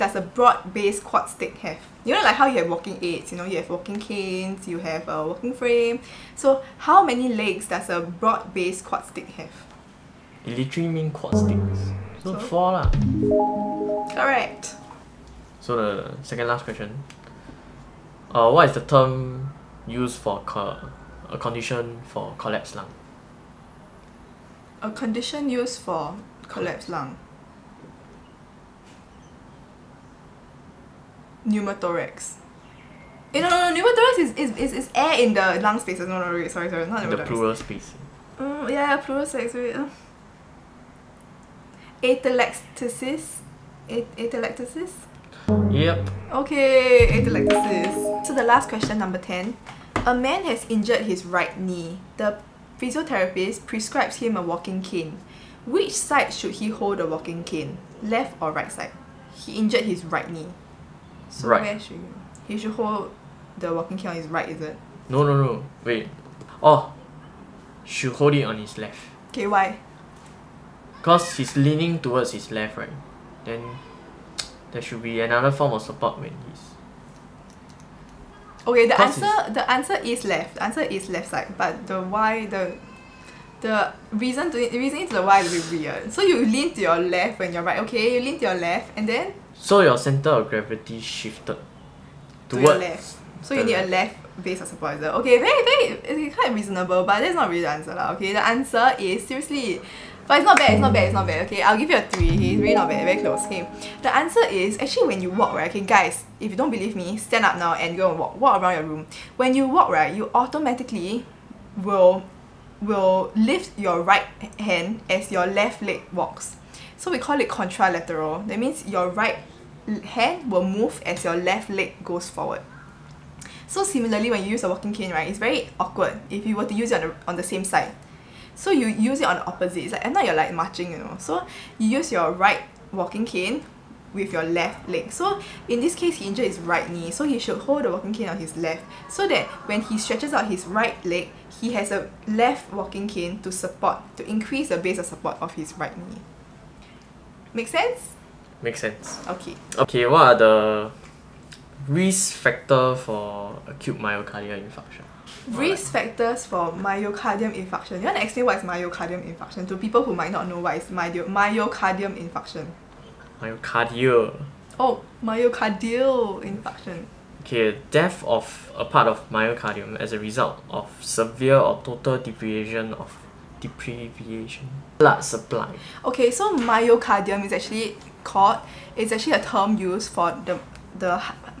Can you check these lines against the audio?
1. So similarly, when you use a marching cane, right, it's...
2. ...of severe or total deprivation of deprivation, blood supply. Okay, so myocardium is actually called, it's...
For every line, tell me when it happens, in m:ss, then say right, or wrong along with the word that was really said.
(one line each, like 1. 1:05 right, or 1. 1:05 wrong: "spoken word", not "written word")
1. 2:03 wrong: "walking", not "marching"
2. 2:50 right.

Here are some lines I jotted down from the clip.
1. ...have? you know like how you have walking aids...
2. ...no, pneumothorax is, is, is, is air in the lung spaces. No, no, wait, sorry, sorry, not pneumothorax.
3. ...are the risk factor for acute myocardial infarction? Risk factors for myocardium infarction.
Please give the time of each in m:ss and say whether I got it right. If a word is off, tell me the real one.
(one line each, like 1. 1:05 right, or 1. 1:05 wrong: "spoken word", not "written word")
1. 0:01 right
2. 0:33 right
3. 2:30 right.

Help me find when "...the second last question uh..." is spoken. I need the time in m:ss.
0:15.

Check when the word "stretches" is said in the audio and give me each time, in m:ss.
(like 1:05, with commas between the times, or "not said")
2:19.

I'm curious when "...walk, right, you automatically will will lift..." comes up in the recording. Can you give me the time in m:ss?
1:49.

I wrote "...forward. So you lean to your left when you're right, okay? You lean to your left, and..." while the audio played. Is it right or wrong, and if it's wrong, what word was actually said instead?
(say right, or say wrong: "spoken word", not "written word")
wrong: "weird", not "forward".